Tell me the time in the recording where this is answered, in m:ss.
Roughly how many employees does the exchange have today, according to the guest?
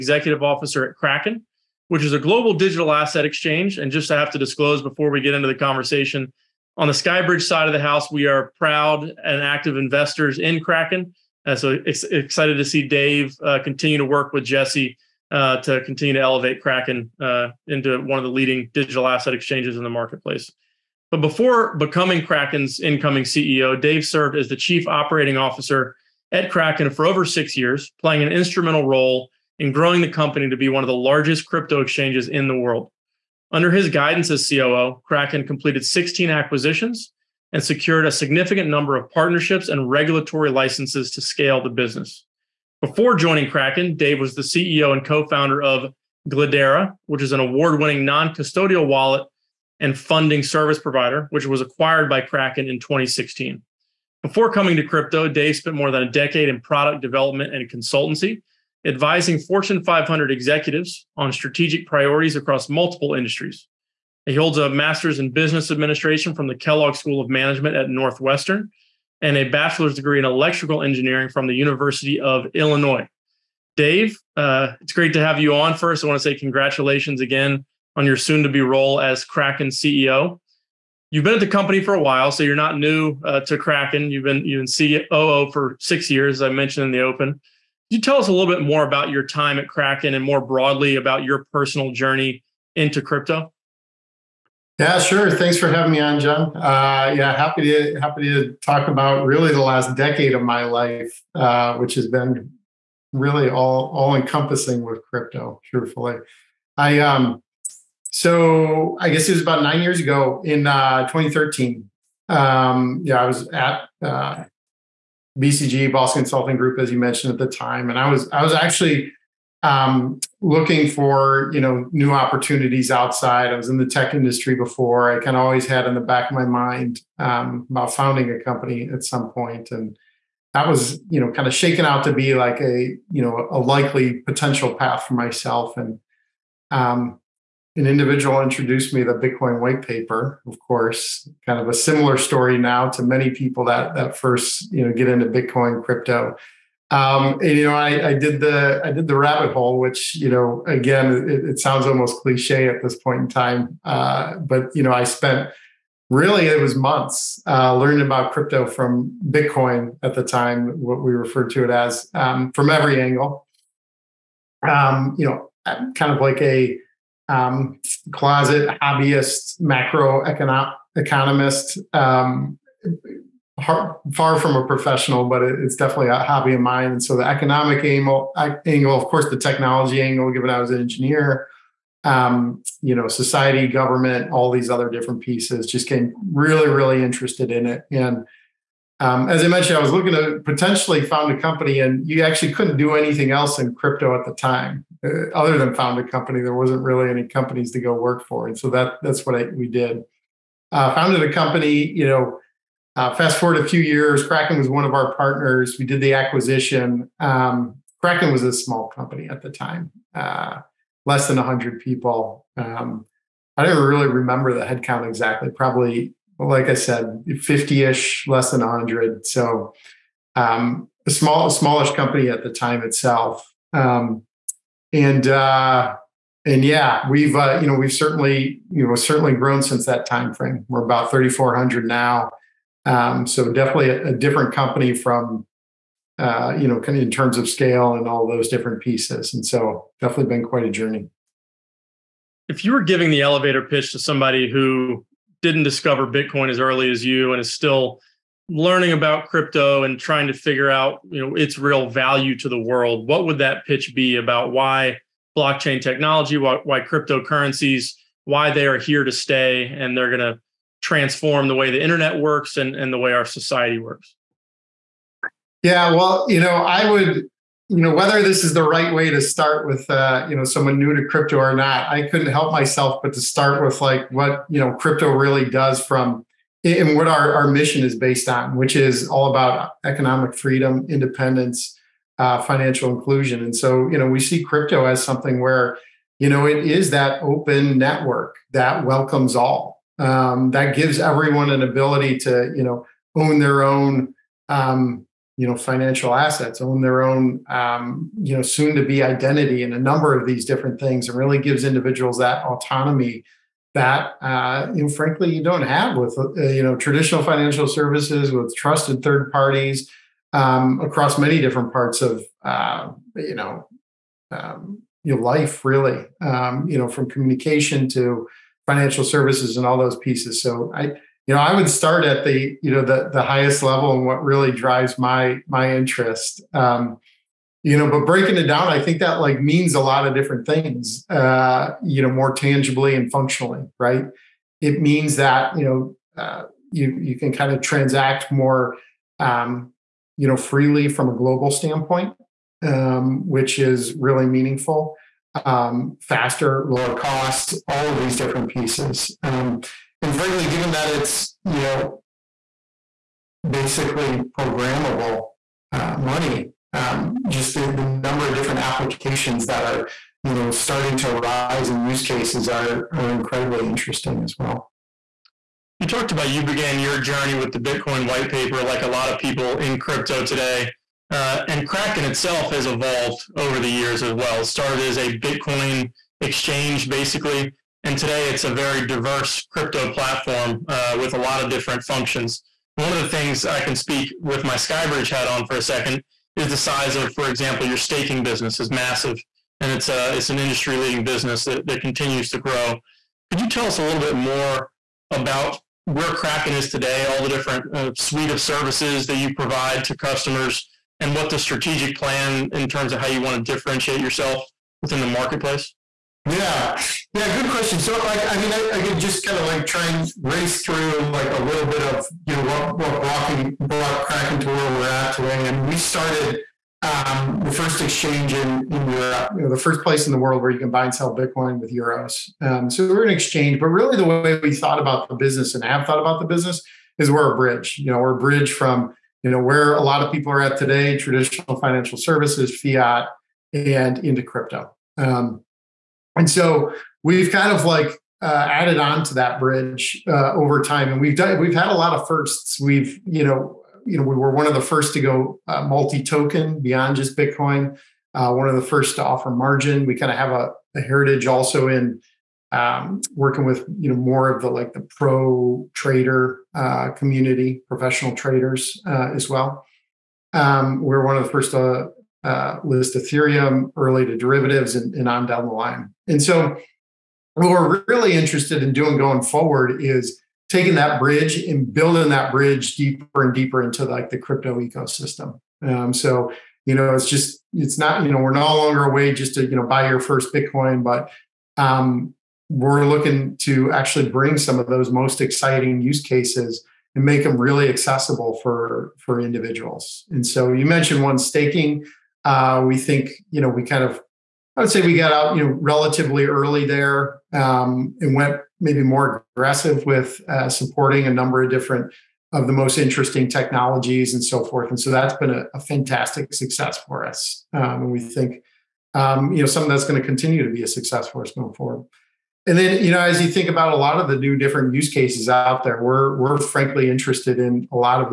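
3:51.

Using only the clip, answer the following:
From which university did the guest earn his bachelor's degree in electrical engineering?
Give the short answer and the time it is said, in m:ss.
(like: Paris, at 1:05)
University of Illinois, at 1:11.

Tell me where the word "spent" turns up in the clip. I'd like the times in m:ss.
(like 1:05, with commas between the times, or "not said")
0:55, 2:35.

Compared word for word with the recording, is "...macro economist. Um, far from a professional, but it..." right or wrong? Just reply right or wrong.
right.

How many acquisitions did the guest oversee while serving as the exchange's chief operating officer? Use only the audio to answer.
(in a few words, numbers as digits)
16.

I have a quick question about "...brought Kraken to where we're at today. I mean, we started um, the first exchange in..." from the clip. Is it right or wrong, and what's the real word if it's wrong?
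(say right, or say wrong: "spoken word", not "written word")
right.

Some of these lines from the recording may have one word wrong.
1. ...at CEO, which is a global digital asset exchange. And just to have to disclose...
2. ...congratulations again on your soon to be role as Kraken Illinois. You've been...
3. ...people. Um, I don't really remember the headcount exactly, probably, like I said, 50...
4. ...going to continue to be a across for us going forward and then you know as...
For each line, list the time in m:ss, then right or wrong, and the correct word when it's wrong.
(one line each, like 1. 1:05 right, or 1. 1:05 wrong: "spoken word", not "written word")
1. 0:00 wrong: "Kraken", not "CEO"
2. 1:16 wrong: "CEO", not "Illinois"
3. 3:31 right
4. 8:29 wrong: "success", not "across".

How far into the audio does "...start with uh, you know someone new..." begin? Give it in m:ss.
4:29.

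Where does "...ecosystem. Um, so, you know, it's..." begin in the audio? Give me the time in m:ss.
7:54.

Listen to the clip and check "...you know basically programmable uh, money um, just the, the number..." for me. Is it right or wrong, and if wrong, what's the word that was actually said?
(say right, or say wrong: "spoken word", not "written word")
right.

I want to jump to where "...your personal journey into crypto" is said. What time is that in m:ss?
1:31.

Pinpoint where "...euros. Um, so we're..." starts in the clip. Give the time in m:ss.
7:01.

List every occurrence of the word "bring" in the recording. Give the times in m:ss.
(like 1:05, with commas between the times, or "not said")
8:04.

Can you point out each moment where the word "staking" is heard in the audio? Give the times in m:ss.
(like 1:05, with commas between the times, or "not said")
6:27, 8:11.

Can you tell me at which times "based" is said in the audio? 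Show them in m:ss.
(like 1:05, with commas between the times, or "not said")
4:37.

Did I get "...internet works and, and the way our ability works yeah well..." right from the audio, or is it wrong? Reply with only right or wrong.
wrong.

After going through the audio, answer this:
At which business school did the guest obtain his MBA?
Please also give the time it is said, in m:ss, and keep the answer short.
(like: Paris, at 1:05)
Kellogg School of Management, at 1:06.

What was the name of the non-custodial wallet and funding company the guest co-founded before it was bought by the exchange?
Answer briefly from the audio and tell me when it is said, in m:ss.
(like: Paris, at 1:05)
Glidera, at 0:46.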